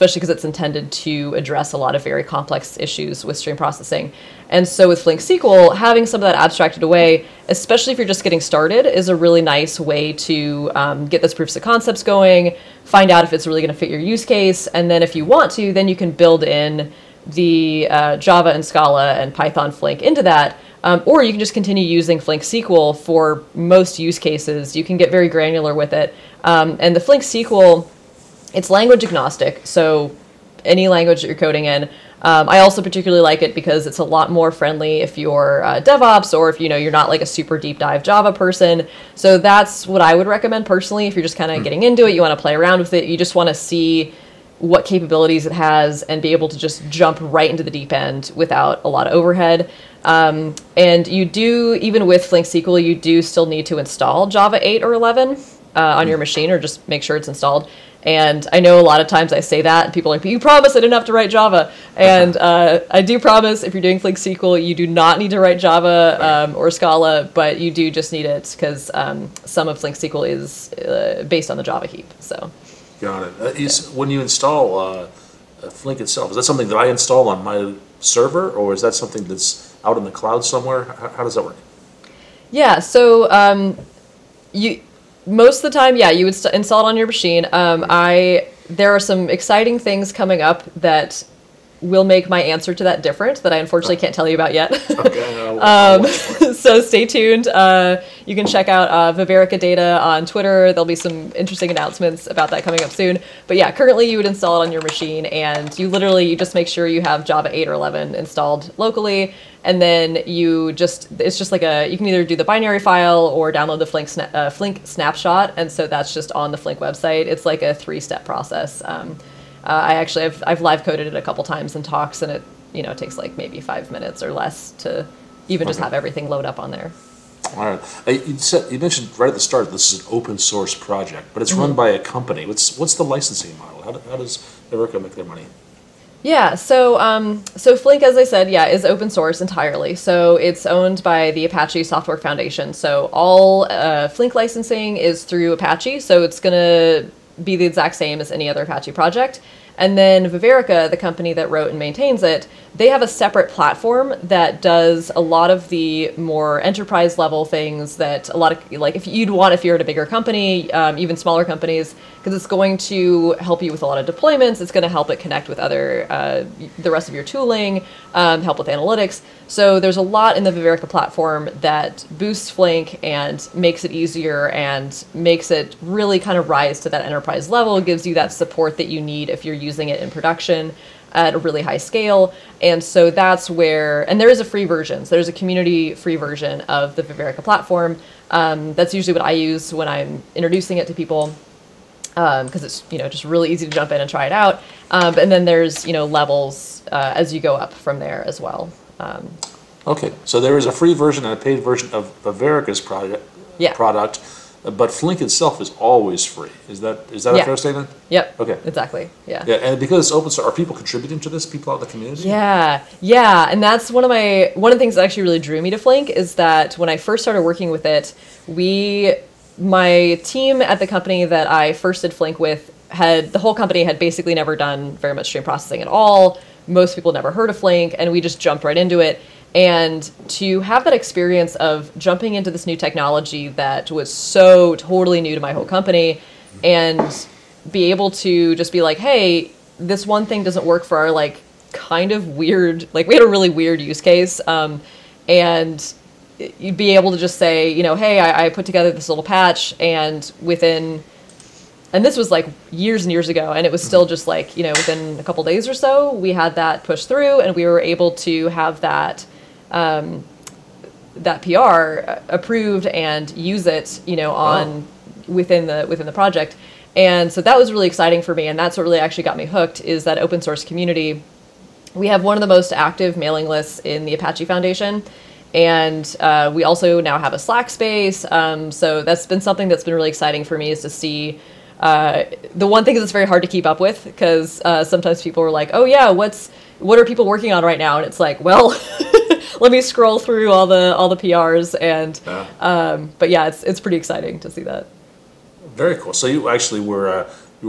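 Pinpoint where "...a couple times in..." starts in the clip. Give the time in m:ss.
2:01.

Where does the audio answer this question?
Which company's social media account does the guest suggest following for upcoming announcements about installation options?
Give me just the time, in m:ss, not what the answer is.
1:39.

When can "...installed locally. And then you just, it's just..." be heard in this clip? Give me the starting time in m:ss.
1:48.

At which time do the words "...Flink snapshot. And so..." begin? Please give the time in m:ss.
1:54.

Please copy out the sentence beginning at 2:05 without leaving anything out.
just have everything load up on there.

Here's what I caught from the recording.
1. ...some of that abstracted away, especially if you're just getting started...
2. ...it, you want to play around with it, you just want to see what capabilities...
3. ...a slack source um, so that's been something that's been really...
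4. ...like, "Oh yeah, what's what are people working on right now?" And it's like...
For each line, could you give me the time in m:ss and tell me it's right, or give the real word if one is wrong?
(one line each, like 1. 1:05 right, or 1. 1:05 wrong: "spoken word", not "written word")
1. 0:06 right
2. 0:42 right
3. 4:37 wrong: "space", not "source"
4. 4:45 right.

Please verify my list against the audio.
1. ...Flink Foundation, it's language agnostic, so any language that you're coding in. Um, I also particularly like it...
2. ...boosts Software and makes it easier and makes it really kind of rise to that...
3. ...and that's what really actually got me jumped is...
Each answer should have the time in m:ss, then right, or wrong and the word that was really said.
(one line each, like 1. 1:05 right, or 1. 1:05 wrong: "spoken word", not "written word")
1. 0:26 wrong: "SQL", not "Foundation"
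2. 2:52 wrong: "Flink", not "Software"
3. 4:28 wrong: "hooked", not "jumped".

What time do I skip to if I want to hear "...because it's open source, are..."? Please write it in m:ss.
3:29.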